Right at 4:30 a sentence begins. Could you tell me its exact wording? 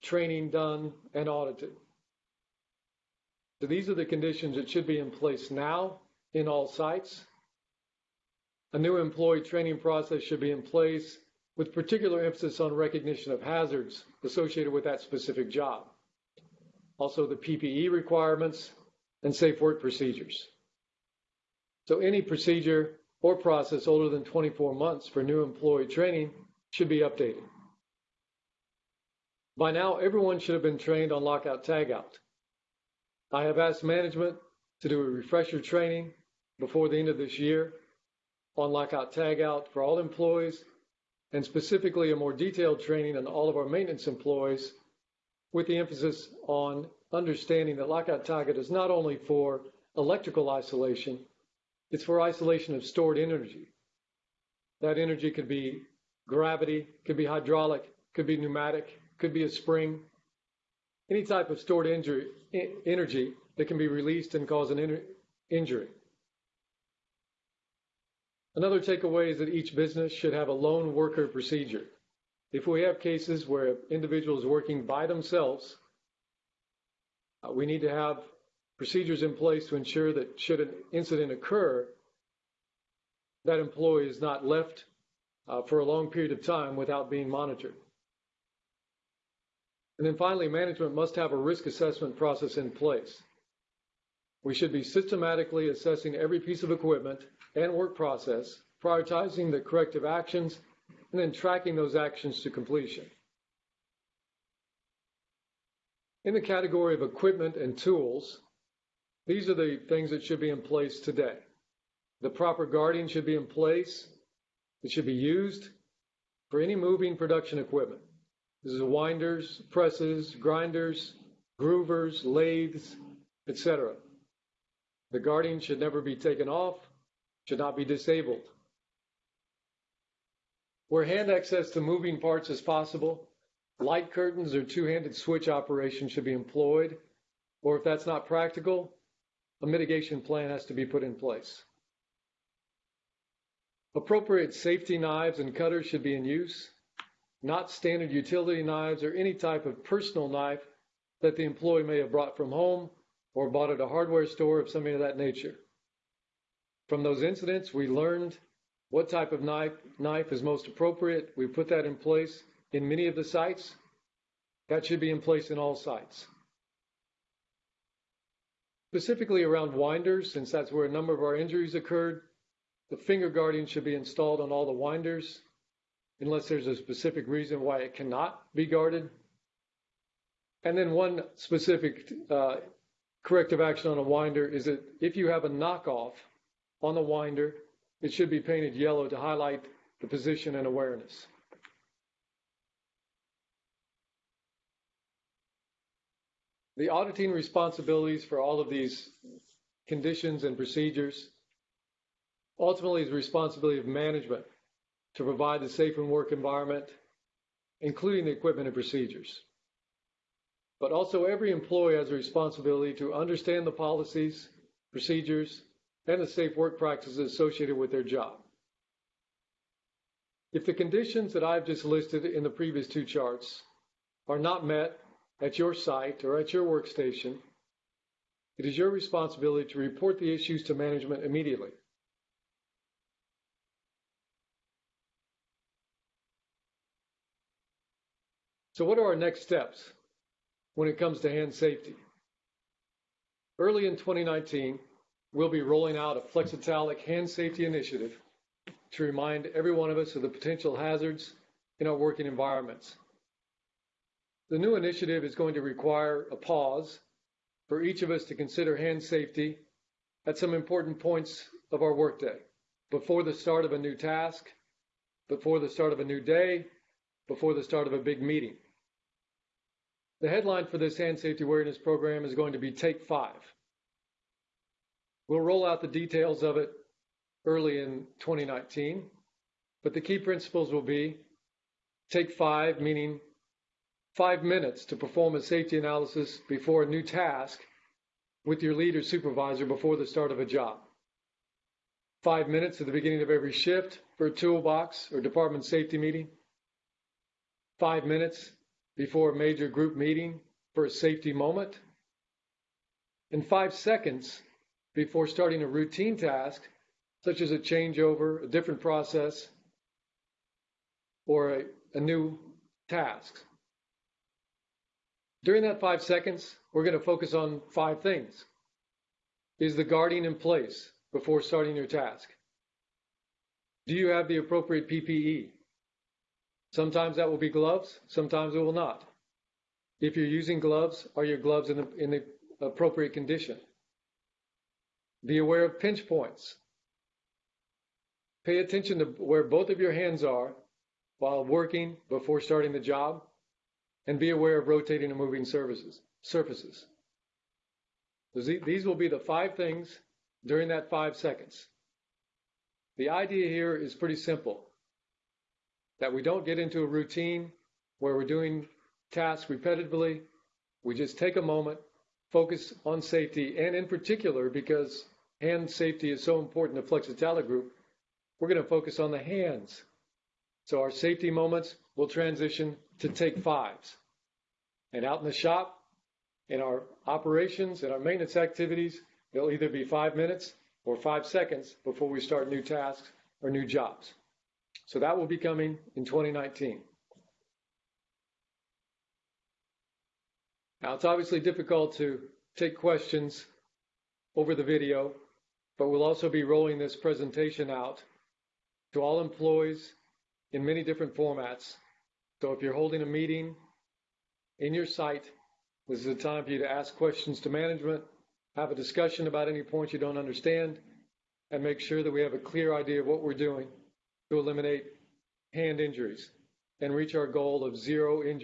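The headline for this hand safety awareness program is going to be Take Five.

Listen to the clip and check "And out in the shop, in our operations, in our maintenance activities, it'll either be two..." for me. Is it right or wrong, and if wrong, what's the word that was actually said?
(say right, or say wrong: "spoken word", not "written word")
wrong: "five", not "two".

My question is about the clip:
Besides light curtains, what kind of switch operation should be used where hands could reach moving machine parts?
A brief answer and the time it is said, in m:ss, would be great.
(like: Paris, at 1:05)
Two-handed switch, at 2:14.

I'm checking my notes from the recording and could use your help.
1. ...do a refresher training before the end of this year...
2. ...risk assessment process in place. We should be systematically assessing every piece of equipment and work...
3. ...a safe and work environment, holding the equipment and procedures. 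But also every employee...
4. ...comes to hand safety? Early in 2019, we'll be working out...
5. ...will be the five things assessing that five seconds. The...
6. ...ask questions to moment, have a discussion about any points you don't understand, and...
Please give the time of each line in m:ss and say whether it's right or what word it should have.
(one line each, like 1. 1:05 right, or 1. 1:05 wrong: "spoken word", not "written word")
1. 0:34 right
2. 1:31 right
3. 3:25 wrong: "including", not "holding"
4. 4:00 wrong: "rolling", not "working"
5. 5:48 wrong: "during", not "assessing"
6. 6:46 wrong: "management", not "moment".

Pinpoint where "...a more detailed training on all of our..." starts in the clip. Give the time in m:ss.
0:42.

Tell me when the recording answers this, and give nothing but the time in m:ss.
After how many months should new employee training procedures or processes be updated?
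0:24.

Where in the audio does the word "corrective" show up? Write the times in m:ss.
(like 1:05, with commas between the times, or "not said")
1:39, 3:03.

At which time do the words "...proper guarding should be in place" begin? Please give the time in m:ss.
1:52.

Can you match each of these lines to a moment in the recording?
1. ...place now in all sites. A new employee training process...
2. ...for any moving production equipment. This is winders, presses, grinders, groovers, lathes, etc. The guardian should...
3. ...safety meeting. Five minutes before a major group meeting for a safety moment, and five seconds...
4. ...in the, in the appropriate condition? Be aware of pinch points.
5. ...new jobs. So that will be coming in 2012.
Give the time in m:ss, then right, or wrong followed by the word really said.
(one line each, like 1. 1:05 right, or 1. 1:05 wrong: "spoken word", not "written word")
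1. 0:05 right
2. 1:56 right
3. 4:55 right
4. 5:31 right
5. 6:23 wrong: "2019", not "2012".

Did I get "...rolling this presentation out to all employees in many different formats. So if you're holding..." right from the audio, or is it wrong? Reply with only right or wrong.
right.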